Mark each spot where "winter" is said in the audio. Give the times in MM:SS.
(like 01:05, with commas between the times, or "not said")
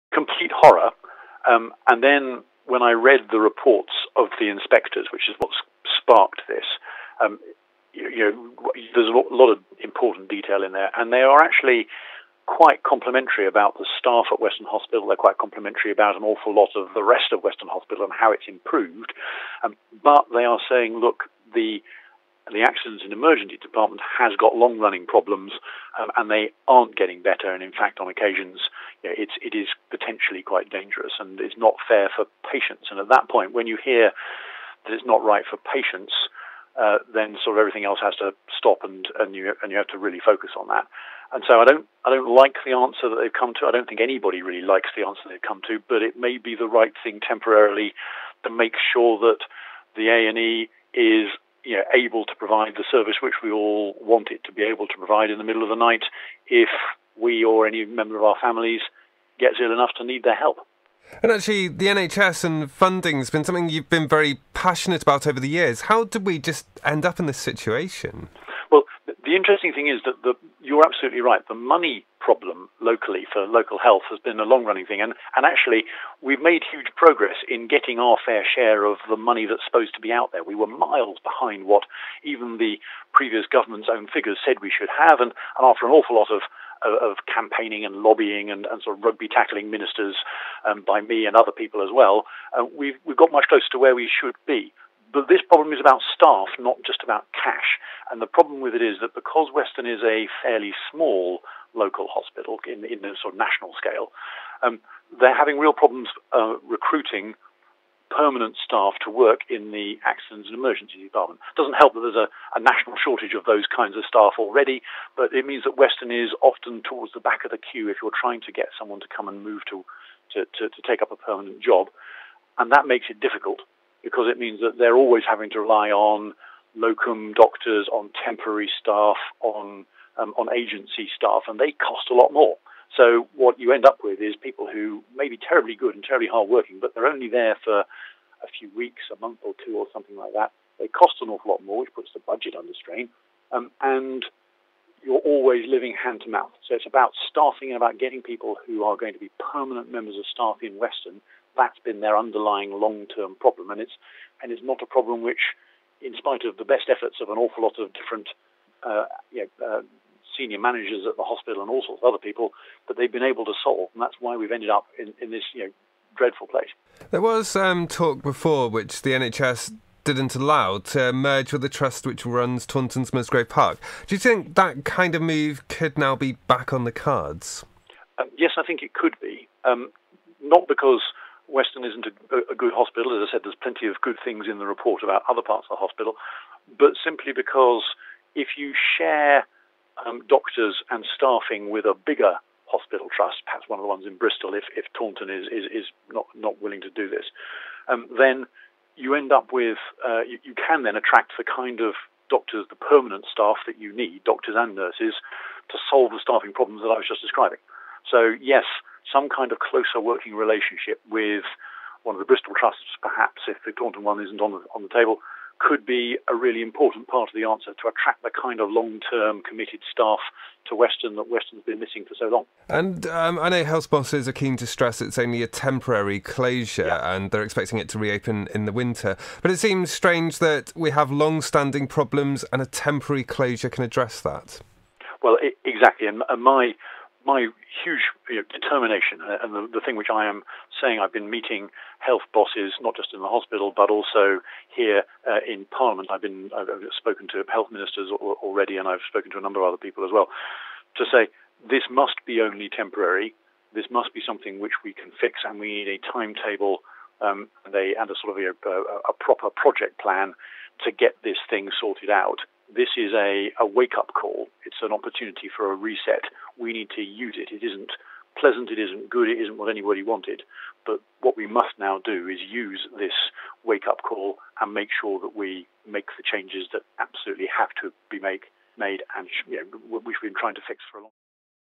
03:48.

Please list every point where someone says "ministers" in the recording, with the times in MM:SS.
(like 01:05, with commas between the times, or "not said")
01:29, 04:07.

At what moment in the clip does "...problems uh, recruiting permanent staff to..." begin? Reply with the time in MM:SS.
01:45.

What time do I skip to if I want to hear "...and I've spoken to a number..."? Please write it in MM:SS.
04:08.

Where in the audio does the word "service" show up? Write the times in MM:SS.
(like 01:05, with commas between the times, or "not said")
00:52.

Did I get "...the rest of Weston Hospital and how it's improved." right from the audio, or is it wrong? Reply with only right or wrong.
right.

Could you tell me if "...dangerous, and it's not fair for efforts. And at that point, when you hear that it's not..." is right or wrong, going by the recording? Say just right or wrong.
wrong.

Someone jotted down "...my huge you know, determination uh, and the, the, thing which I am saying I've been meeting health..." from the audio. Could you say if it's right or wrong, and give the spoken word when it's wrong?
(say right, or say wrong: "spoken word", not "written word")
right.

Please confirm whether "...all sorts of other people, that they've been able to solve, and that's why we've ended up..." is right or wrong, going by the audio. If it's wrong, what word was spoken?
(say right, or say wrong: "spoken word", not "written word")
right.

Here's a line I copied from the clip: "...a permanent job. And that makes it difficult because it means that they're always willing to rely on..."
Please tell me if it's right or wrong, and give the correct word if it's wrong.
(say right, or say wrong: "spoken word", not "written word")
wrong: "having", not "willing".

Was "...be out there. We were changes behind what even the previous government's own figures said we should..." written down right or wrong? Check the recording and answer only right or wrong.
wrong.